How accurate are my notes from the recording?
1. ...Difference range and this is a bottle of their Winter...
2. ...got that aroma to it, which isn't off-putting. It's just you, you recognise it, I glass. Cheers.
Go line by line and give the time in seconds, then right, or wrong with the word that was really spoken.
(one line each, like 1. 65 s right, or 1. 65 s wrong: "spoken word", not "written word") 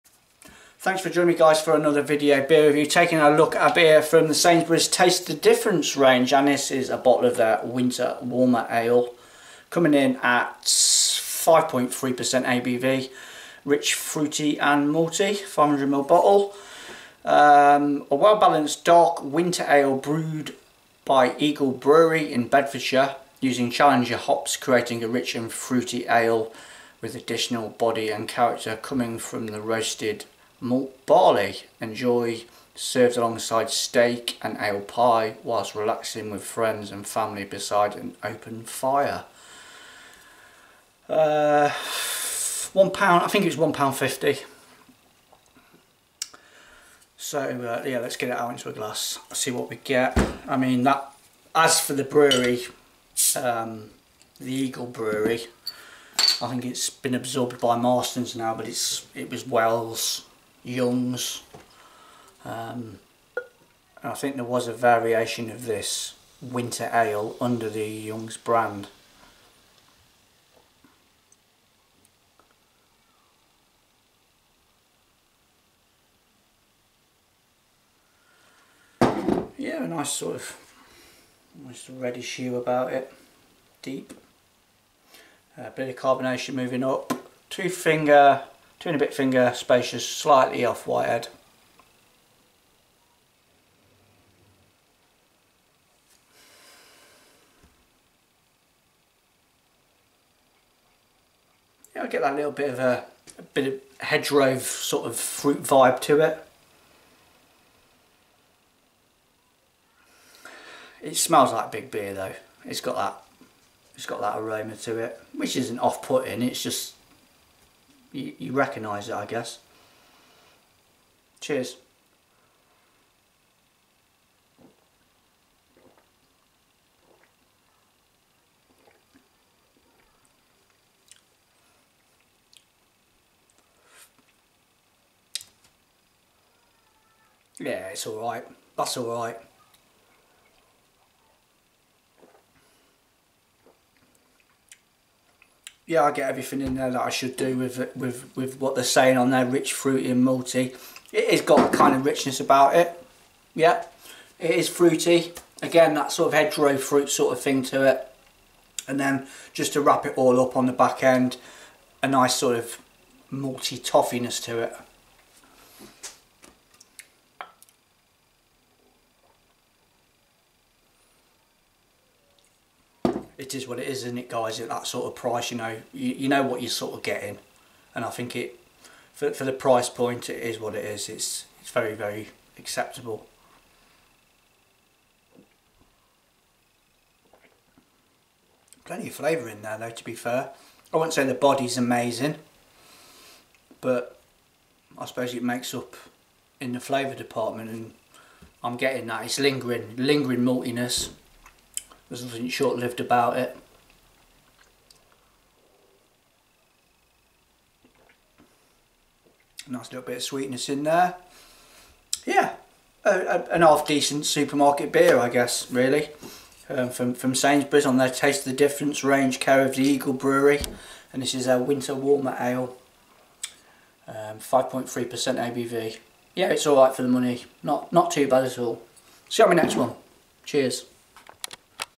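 1. 5 s right
2. 114 s wrong: "guess", not "glass".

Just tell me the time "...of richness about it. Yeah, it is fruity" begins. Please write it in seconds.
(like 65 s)
151 s.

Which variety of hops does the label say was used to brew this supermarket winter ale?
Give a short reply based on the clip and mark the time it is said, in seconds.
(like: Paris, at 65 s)
Challenger, at 23 s.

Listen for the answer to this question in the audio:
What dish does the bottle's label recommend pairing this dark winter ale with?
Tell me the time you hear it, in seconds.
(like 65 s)
33 s.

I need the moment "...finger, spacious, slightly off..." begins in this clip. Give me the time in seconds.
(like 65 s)
89 s.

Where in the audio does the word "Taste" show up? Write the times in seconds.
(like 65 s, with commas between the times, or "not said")
4 s, 218 s.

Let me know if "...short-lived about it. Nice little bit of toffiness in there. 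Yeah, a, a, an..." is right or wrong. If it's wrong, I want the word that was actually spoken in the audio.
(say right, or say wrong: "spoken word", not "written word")
wrong: "sweetness", not "toffiness".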